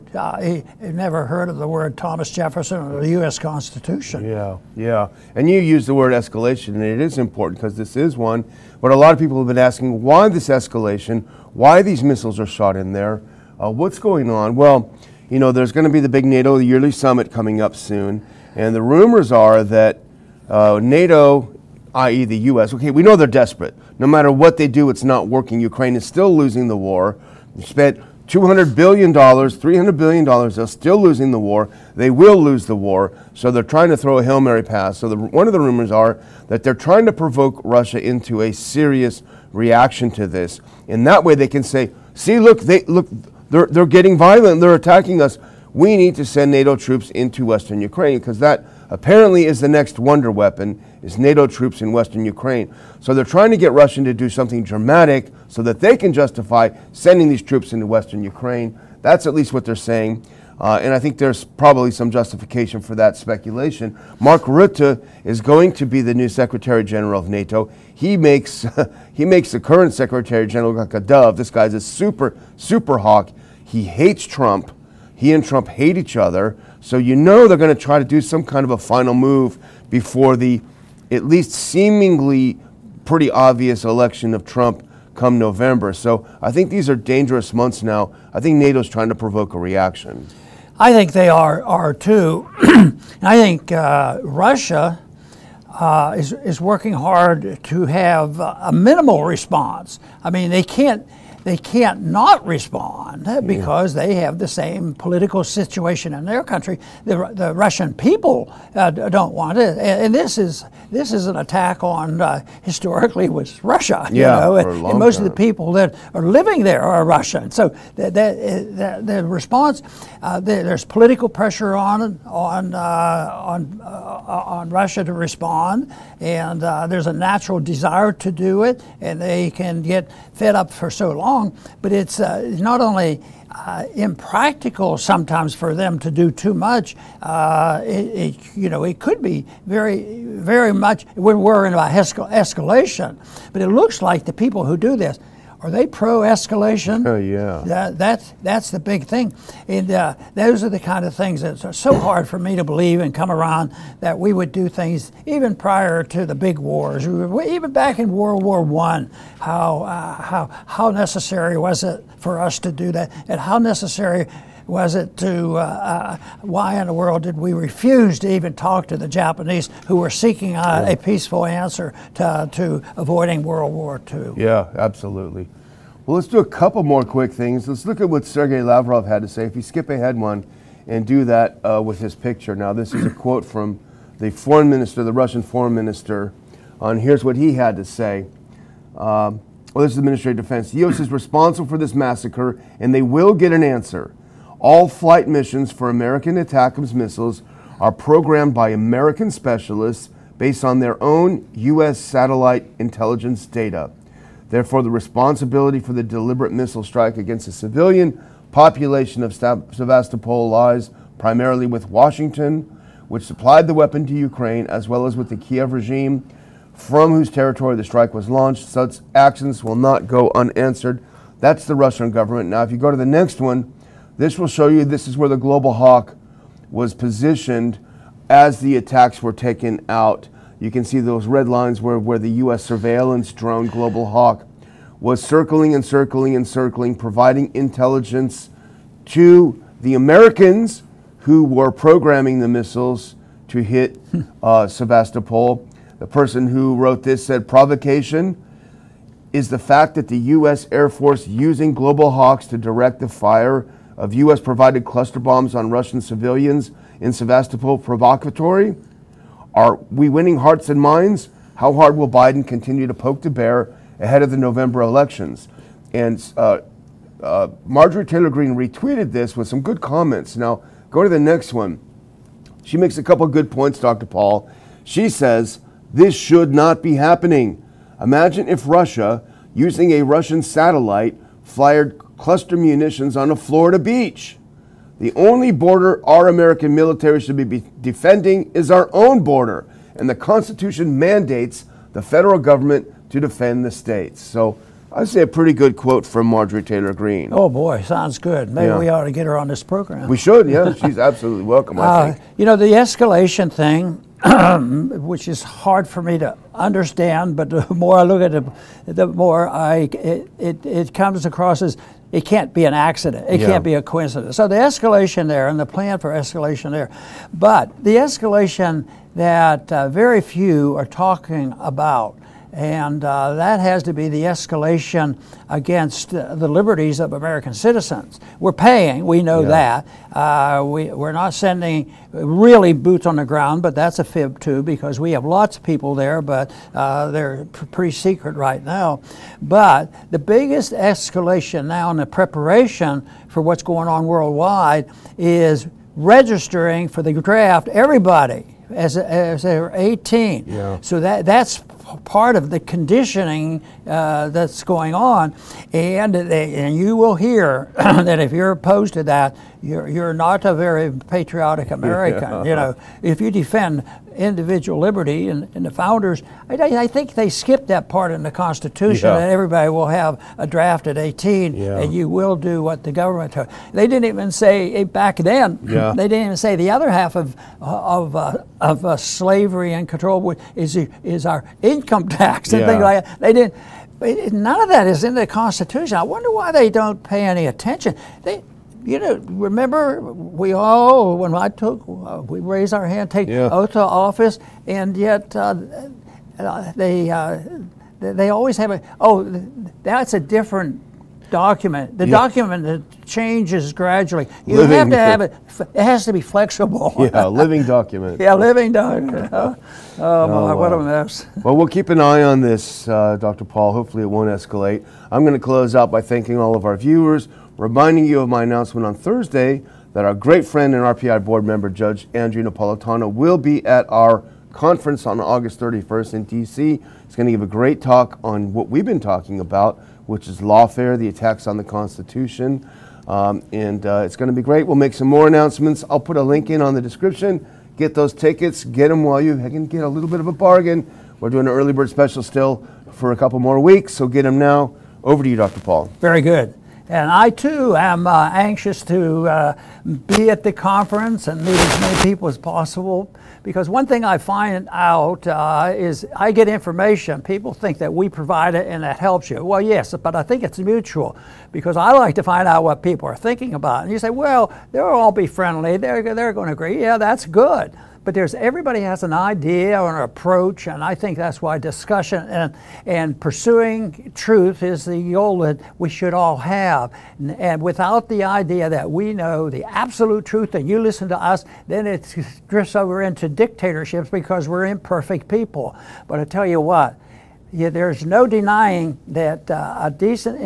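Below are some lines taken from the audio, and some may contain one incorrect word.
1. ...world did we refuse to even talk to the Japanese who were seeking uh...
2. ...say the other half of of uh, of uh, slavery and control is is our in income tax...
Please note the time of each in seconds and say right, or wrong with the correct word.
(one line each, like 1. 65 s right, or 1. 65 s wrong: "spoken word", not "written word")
1. 166 s right
2. 376 s right.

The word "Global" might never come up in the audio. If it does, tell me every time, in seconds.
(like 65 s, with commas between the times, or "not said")
225 s, 233 s, 251 s.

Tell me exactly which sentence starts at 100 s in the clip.
I mean, they can't they can't not respond because they have the same political situation in their country.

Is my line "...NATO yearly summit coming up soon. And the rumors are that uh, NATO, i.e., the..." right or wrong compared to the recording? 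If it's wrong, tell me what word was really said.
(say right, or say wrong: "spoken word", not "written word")
right.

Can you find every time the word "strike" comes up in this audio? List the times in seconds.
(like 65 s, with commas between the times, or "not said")
206 s, 217 s.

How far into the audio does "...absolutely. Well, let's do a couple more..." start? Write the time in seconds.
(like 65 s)
174 s.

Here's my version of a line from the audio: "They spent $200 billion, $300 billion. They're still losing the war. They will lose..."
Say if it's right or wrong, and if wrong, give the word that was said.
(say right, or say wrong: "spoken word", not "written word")
right.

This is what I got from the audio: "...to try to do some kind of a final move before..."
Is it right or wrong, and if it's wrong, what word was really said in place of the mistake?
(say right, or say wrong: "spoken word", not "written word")
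right.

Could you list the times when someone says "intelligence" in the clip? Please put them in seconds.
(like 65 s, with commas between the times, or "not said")
202 s, 237 s.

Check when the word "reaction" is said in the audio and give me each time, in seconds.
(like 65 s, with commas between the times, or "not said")
39 s, 89 s.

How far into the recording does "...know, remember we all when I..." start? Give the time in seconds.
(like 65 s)
388 s.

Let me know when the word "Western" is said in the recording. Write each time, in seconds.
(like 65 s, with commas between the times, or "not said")
47 s, 51 s, 57 s.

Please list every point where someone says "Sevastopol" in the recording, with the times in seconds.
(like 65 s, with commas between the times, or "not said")
209 s, 244 s, 257 s.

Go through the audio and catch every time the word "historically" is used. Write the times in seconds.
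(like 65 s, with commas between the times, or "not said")
112 s.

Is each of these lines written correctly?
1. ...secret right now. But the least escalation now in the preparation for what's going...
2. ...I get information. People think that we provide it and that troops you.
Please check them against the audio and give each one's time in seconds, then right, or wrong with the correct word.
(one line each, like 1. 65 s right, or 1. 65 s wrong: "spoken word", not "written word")
1. 337 s wrong: "biggest", not "least"
2. 456 s wrong: "helps", not "troops".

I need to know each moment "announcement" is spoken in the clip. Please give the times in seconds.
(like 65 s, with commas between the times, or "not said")
418 s, 435 s.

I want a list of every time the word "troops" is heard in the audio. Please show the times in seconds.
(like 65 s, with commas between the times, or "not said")
46 s, 51 s, 57 s.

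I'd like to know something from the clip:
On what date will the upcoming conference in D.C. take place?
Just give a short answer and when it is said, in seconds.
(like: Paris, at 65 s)
August 31, at 425 s.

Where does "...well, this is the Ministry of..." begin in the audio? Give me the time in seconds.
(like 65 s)
189 s.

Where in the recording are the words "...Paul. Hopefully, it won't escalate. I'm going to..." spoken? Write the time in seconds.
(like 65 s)
413 s.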